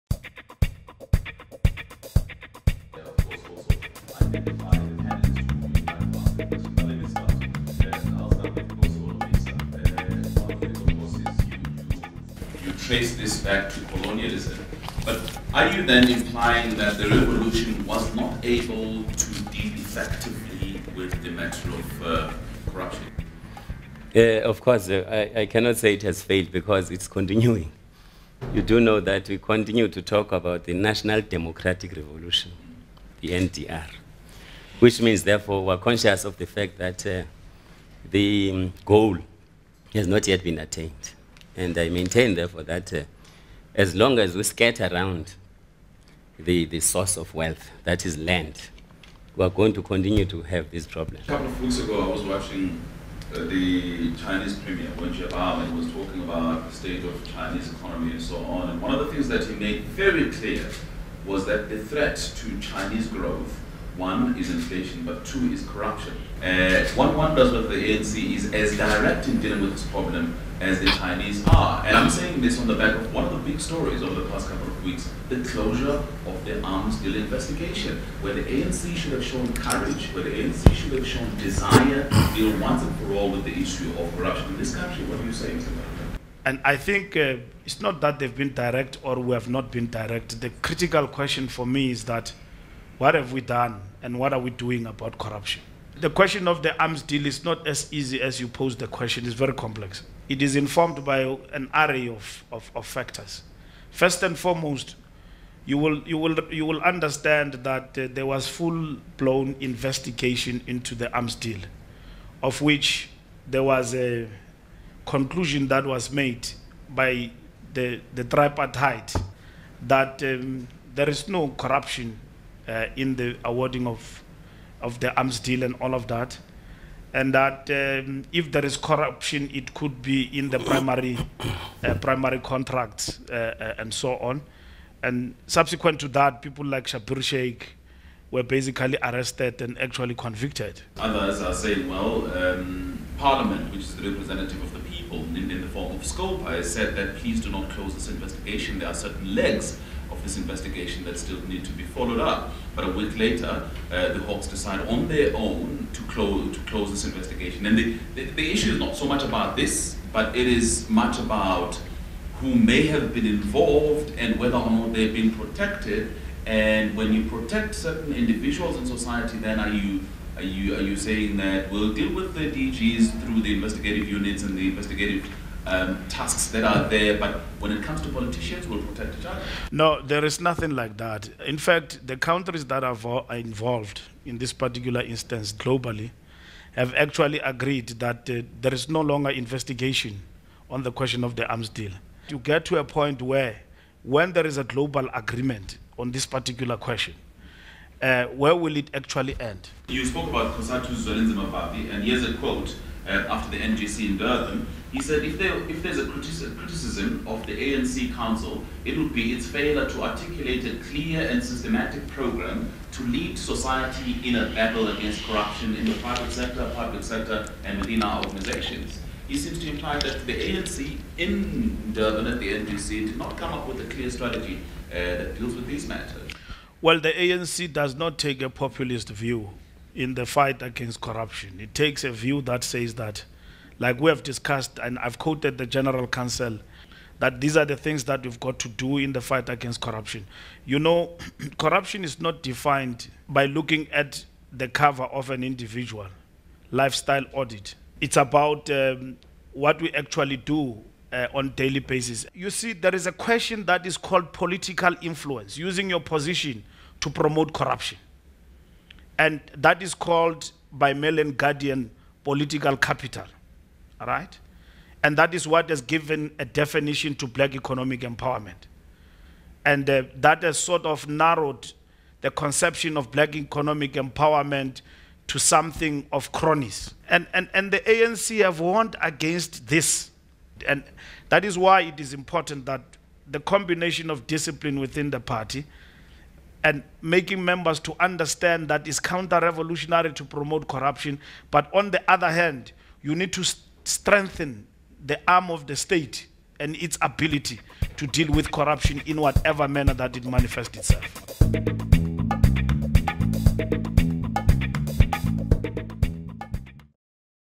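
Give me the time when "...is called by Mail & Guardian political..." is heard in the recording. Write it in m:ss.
4:19.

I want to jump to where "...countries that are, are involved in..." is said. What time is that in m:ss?
3:02.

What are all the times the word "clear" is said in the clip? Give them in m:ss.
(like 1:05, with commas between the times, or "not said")
1:00, 3:30, 3:43.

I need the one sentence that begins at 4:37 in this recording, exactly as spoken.
And, and, and the ANC have warned against this.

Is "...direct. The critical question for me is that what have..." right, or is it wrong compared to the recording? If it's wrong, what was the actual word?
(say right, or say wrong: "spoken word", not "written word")
right.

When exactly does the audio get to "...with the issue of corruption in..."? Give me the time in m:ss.
1:23.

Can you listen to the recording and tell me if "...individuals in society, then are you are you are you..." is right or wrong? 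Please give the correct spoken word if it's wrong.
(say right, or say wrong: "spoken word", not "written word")
right.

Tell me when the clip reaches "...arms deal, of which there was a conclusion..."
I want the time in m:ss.
1:51.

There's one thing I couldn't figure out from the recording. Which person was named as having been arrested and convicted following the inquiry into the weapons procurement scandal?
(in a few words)
Schabir Shaik.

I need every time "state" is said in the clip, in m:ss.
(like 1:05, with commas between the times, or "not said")
0:56, 4:55.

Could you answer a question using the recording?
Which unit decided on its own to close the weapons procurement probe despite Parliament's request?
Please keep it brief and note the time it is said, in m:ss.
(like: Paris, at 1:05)
the Hawks, at 2:34.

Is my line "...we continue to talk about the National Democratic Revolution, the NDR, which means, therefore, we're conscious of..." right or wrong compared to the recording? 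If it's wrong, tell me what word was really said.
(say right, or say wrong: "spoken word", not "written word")
right.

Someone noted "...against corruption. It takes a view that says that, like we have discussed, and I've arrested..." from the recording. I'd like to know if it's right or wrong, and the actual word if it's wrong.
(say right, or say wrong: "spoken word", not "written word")
wrong: "quoted", not "arrested".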